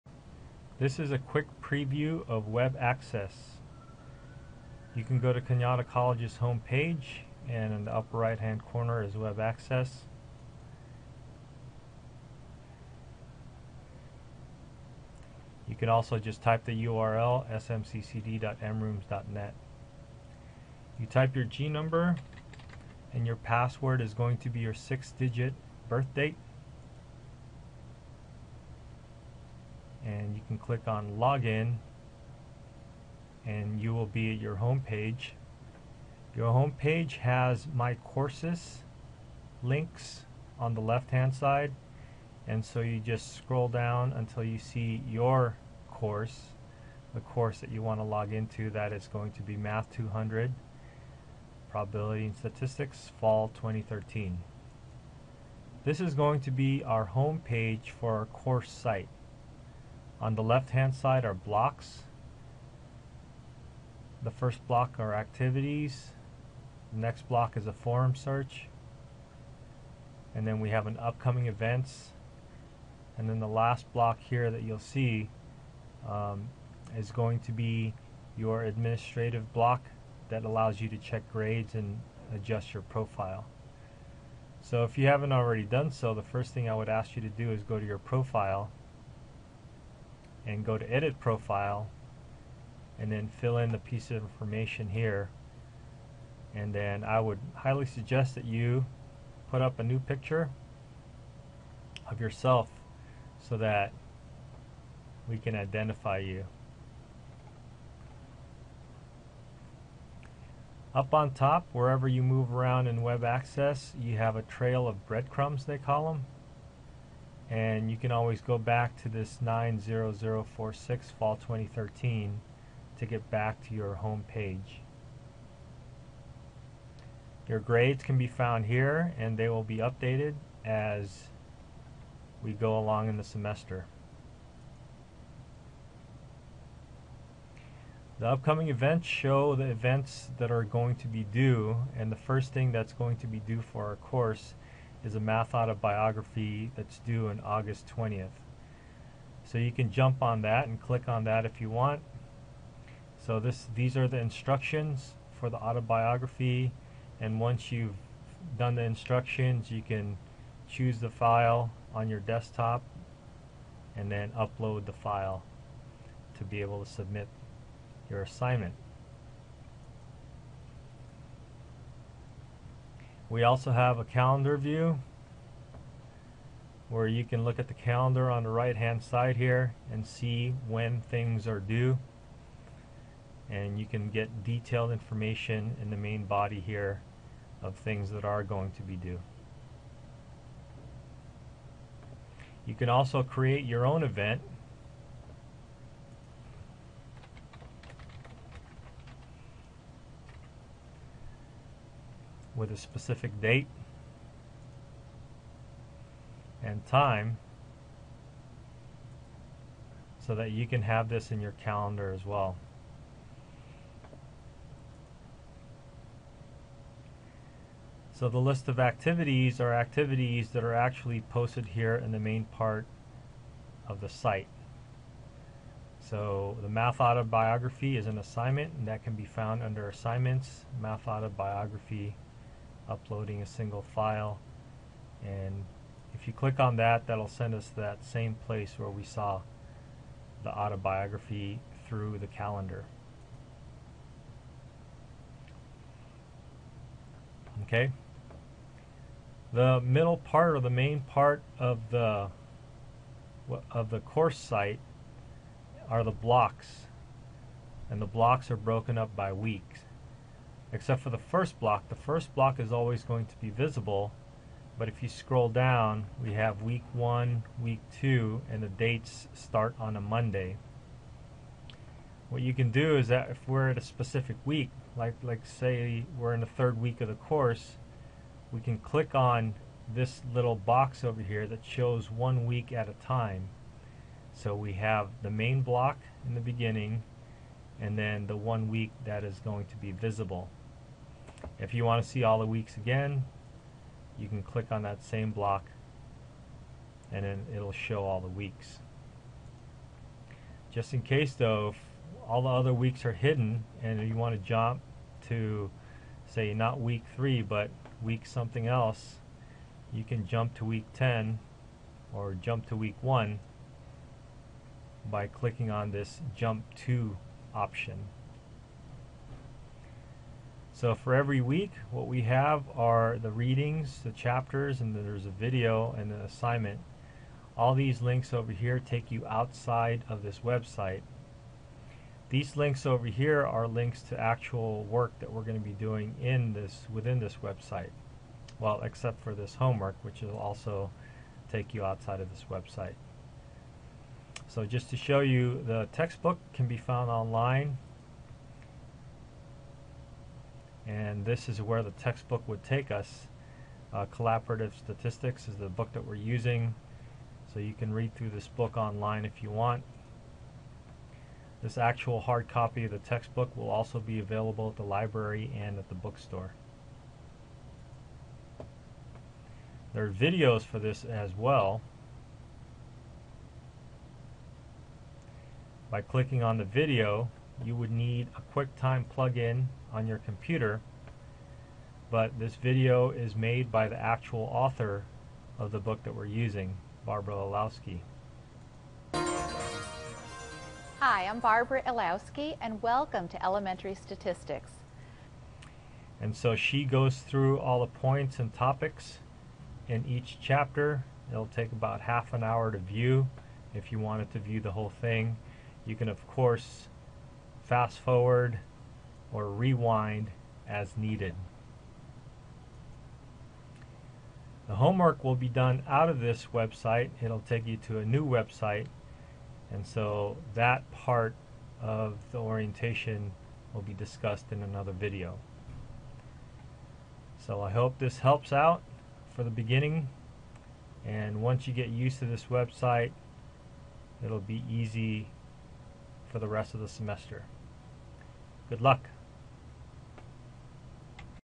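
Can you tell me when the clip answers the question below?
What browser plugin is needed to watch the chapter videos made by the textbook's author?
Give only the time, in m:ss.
6:18.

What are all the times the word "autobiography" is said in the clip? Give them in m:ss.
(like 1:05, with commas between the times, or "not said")
2:25, 2:35, 3:47, 3:51, 4:00.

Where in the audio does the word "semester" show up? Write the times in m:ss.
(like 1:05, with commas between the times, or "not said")
2:13, 7:16.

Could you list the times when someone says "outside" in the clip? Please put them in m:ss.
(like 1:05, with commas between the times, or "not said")
5:29, 5:41.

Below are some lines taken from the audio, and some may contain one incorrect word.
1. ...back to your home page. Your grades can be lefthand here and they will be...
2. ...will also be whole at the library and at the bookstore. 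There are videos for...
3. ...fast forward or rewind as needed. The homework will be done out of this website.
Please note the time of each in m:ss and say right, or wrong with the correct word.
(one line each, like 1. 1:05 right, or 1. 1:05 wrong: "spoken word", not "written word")
1. 2:03 wrong: "found", not "lefthand"
2. 6:03 wrong: "available", not "whole"
3. 6:47 right.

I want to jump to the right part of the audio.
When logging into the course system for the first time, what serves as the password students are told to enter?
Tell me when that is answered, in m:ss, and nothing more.
0:24.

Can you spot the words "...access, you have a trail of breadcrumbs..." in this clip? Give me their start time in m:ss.
1:53.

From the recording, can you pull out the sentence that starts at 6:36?
And so she goes through all the points and topics in each chapter.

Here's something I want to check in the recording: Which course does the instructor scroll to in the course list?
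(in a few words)
Math 200.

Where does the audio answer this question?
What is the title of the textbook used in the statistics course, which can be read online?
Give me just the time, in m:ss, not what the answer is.
5:54.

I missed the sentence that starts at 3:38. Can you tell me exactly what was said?
So the list of activities are activities that are actually posted here in the main part of the site.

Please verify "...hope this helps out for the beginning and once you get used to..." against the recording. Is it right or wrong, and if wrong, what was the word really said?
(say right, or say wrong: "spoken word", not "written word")
right.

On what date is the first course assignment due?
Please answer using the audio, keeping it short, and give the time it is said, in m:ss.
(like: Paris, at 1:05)
August 20th, at 2:27.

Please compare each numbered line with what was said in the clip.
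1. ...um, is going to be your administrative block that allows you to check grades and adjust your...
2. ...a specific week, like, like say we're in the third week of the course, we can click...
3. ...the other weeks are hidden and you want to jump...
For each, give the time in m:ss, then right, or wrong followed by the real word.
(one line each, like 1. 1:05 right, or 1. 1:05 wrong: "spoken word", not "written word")
1. 1:16 right
2. 4:33 right
3. 5:02 right.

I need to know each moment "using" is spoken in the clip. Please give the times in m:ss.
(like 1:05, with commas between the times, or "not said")
5:56, 6:26.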